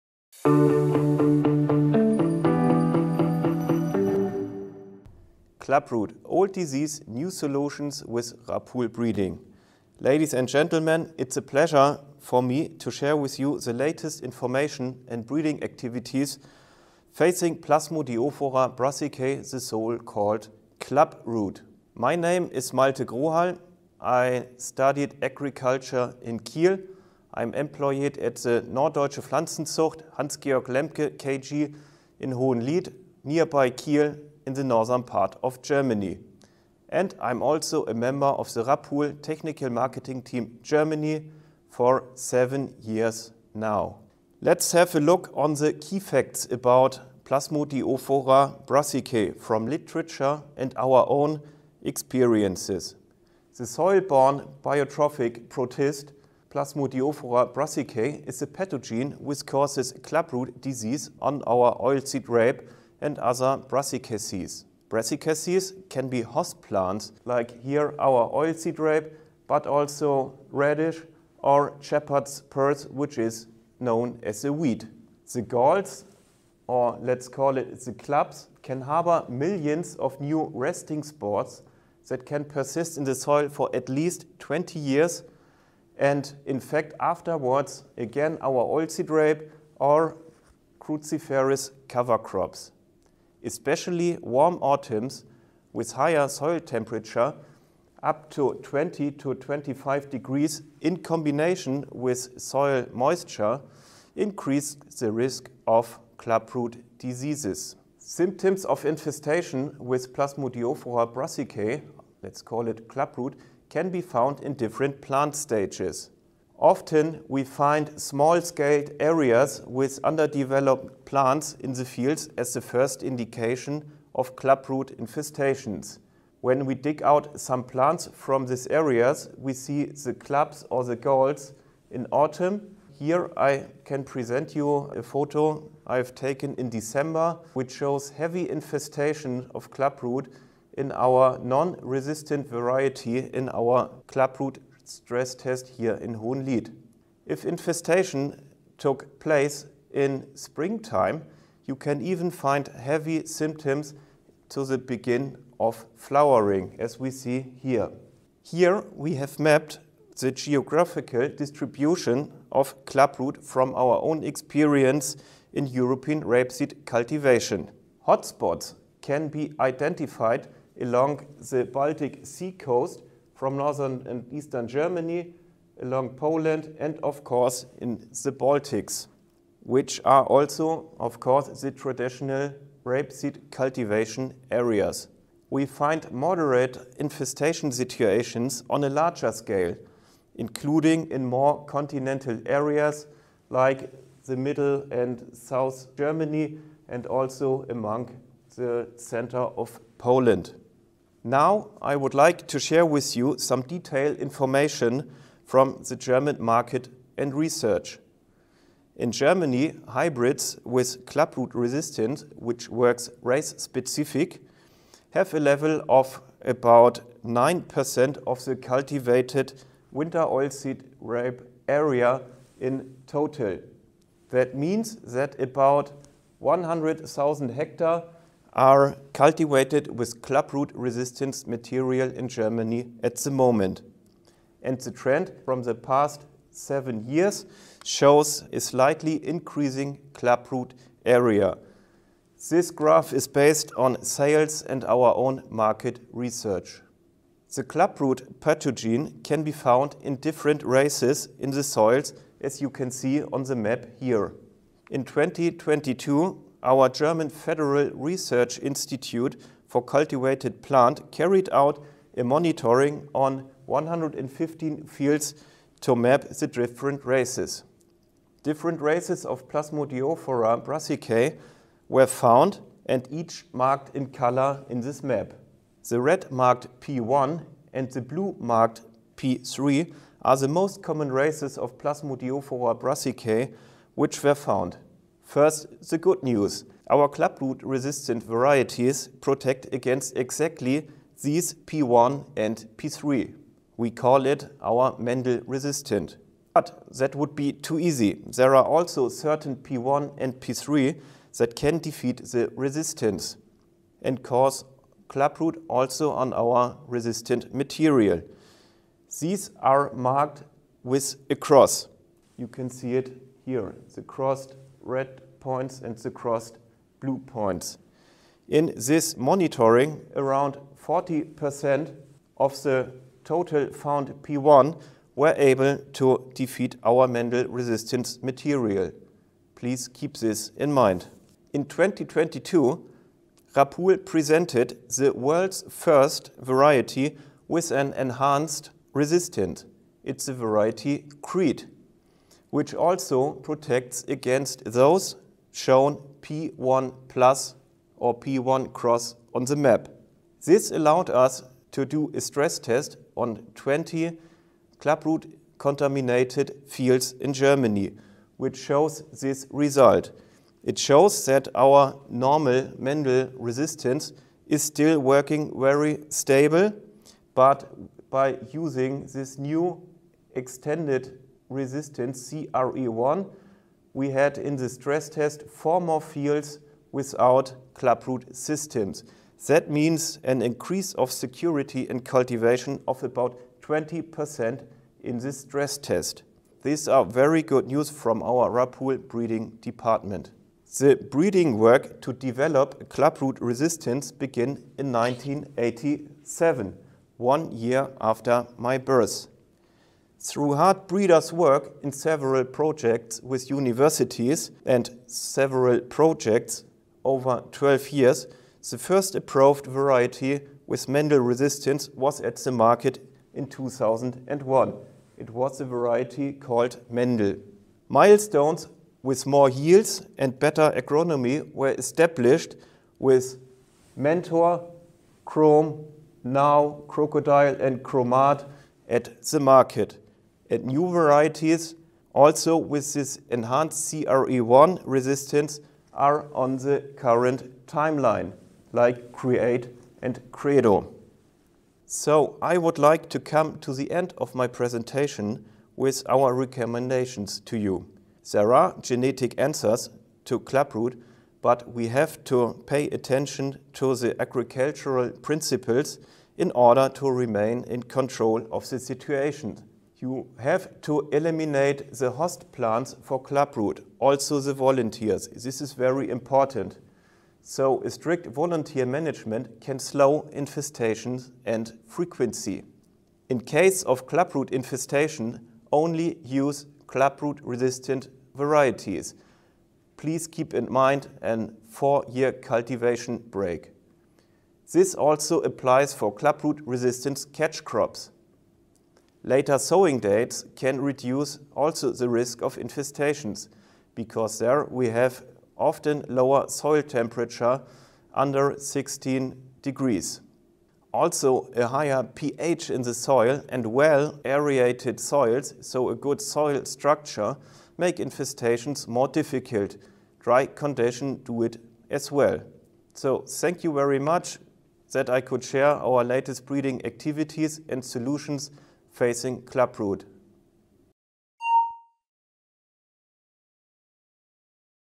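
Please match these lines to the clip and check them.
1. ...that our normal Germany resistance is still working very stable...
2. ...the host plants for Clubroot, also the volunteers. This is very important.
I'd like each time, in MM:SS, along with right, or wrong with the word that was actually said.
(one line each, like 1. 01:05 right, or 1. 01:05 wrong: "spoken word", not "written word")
1. 06:01 wrong: "Mendel", not "Germany"
2. 07:41 right.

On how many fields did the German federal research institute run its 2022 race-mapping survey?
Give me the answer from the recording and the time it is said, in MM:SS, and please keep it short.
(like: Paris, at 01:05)
115, at 04:23.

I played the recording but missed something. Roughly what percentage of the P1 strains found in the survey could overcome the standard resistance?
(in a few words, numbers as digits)
40%.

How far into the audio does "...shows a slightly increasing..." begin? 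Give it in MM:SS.
03:57.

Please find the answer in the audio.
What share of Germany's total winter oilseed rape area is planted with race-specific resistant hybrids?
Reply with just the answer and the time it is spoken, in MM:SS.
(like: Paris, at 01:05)
9%, at 03:37.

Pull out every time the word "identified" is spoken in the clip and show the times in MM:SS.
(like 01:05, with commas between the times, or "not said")
02:49.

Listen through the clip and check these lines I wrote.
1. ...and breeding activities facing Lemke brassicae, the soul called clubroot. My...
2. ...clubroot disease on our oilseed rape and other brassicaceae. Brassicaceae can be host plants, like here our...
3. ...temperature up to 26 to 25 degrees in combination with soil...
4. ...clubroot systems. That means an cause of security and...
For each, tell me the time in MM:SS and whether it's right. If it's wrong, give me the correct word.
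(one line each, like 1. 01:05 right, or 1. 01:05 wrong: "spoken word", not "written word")
1. 00:15 wrong: "Plasmodiophora", not "Lemke"
2. 01:00 right
3. 01:36 wrong: "20", not "26"
4. 06:17 wrong: "increase", not "cause".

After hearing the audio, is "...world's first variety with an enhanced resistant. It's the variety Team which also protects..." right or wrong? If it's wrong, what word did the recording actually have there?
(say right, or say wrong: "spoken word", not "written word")
wrong: "Crete", not "Team".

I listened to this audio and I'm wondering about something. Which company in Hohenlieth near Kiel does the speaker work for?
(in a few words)
Norddeutsche Pflanzenzucht Hans-Georg Lemke KG.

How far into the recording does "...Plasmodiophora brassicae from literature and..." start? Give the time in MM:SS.
00:47.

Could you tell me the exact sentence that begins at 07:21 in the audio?
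So I would like to come to the end of my presentation with our recommendations to you.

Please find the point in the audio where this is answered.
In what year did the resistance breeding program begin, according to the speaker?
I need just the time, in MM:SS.
06:34.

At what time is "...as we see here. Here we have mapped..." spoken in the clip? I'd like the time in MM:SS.
02:36.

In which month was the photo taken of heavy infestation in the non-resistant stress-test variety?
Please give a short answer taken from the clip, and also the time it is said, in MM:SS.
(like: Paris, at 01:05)
December, at 02:16.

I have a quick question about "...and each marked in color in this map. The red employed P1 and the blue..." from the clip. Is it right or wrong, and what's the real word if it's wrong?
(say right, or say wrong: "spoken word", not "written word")
wrong: "marked", not "employed".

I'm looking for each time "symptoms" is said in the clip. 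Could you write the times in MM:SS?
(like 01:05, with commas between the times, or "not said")
01:47, 02:33.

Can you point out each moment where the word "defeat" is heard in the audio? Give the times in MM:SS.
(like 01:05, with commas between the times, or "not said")
05:01, 05:26.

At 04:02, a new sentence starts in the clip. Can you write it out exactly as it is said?
This graph is based on sales and our own market research.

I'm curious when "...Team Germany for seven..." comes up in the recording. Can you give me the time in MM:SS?
00:40.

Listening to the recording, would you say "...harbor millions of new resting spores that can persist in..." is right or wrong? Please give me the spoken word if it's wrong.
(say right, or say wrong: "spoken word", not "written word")
right.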